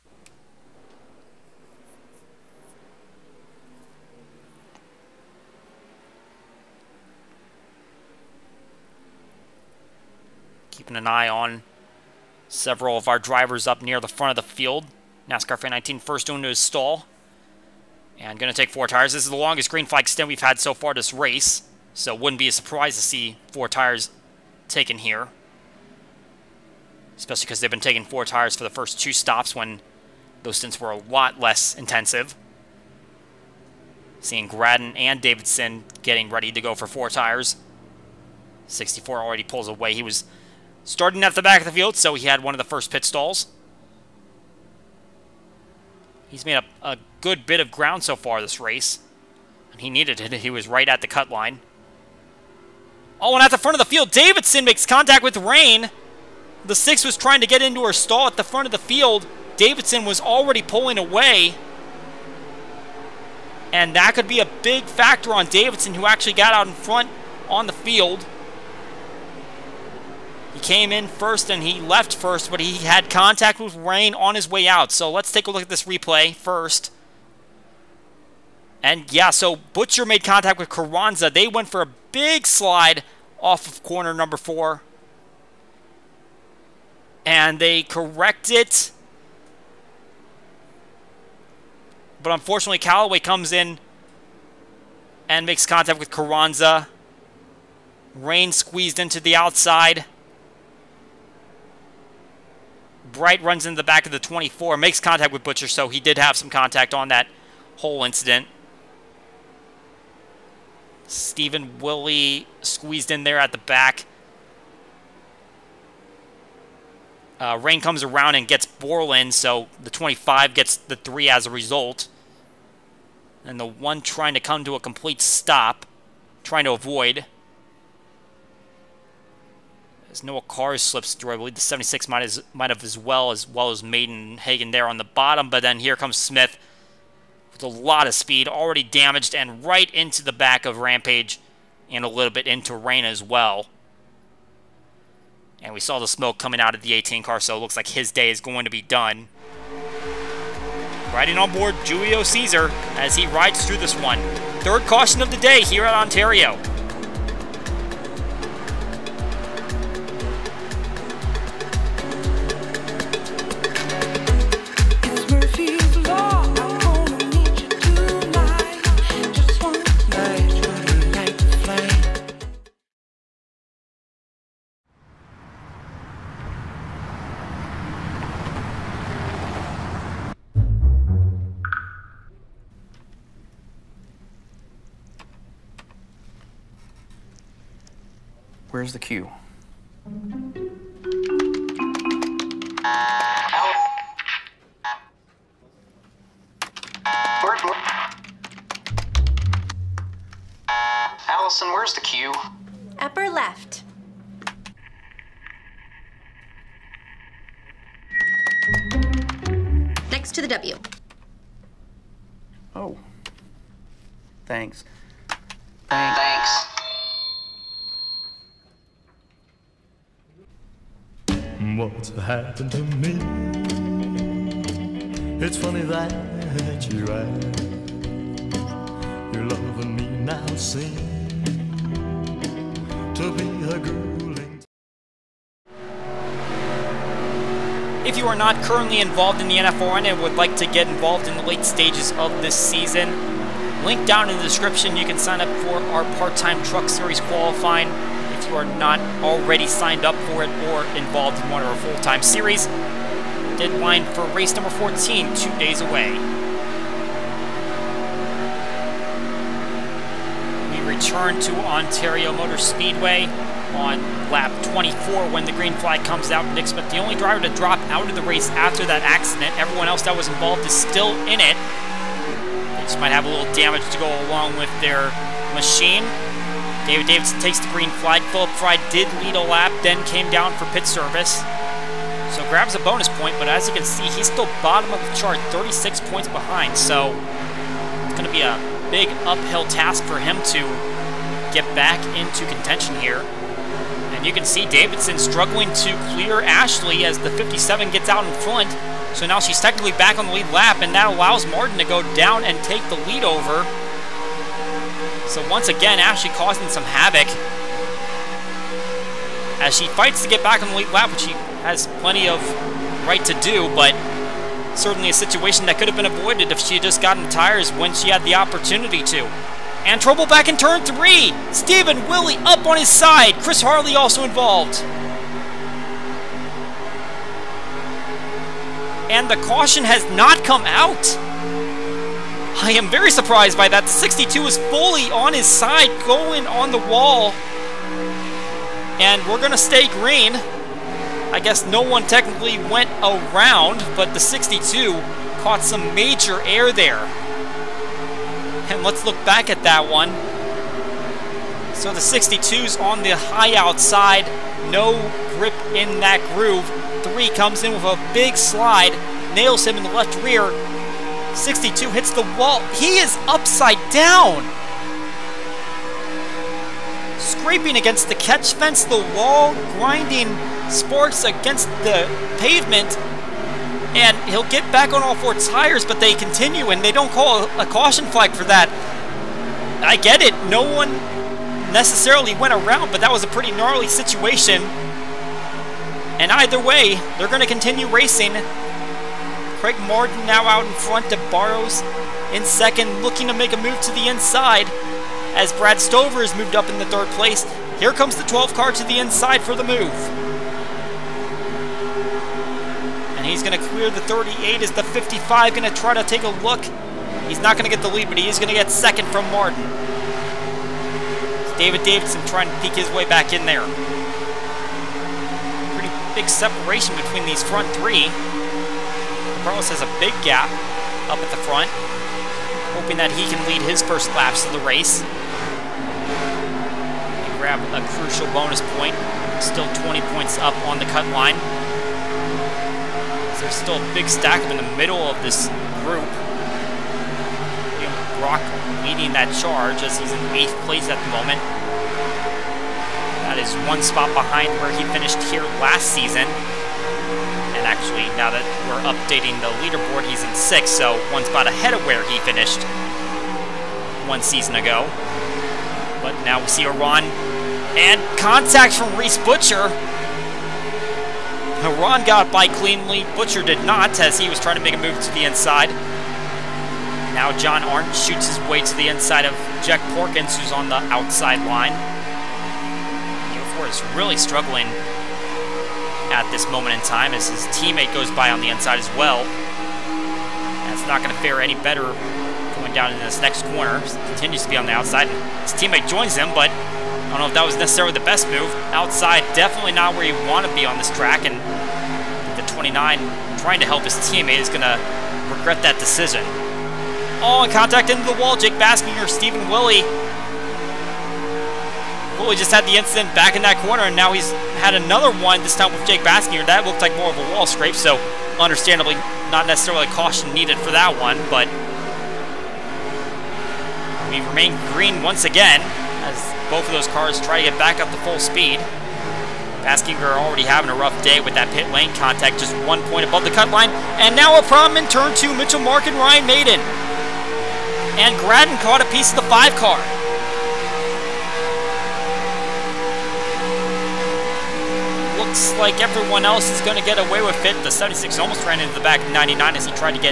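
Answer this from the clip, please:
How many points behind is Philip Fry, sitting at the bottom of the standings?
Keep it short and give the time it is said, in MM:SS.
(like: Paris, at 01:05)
36, at 04:45.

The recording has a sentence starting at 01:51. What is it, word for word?
Stephen Willie squeezed in there at the back.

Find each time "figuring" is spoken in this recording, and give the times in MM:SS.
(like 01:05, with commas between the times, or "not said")
not said.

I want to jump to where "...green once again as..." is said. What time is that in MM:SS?
08:34.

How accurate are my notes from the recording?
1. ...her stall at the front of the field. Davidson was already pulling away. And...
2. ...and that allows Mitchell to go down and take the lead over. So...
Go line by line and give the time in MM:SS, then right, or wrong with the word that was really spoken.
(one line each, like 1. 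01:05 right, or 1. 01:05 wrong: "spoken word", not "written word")
1. 00:57 right
2. 05:00 wrong: "Martin", not "Mitchell".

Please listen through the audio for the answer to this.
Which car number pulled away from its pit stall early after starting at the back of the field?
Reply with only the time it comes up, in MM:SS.
00:38.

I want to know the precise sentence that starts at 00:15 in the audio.
NASCAR Fan 19 first into his stall.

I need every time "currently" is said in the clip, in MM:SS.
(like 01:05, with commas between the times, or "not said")
03:58.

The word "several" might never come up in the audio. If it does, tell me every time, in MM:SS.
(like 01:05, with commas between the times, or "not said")
00:12.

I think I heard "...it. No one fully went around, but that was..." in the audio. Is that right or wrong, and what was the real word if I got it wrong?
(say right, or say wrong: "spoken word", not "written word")
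wrong: "necessarily", not "fully".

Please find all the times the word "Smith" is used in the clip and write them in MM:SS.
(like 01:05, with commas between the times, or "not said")
02:16, 04:26.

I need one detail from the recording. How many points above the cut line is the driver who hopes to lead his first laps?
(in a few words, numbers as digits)
20.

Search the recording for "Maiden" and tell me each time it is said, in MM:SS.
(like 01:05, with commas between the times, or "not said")
02:13, 08:46.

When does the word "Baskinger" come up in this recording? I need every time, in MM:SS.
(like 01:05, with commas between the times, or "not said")
08:18, 08:25, 08:39.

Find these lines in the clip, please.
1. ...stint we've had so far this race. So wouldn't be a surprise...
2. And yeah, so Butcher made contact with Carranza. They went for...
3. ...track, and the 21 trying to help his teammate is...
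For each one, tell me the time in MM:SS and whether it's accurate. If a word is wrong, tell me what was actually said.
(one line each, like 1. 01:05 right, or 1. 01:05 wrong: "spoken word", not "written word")
1. 00:20 right
2. 01:18 right
3. 08:10 wrong: "29", not "21".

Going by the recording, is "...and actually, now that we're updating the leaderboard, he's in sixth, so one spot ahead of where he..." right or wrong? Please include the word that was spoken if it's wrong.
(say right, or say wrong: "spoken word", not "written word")
right.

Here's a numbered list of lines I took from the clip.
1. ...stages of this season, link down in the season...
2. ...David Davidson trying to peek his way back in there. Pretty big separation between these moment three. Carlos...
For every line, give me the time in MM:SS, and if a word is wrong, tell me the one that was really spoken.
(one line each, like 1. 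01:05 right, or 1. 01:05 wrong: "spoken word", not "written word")
1. 04:01 wrong: "description", not "season"
2. 06:51 wrong: "front", not "moment".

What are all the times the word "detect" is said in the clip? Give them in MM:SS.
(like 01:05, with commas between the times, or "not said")
not said.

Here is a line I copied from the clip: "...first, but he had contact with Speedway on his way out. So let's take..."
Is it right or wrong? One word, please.
wrong.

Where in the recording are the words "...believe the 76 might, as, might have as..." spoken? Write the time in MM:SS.
02:11.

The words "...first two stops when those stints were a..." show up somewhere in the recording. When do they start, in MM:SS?
00:28.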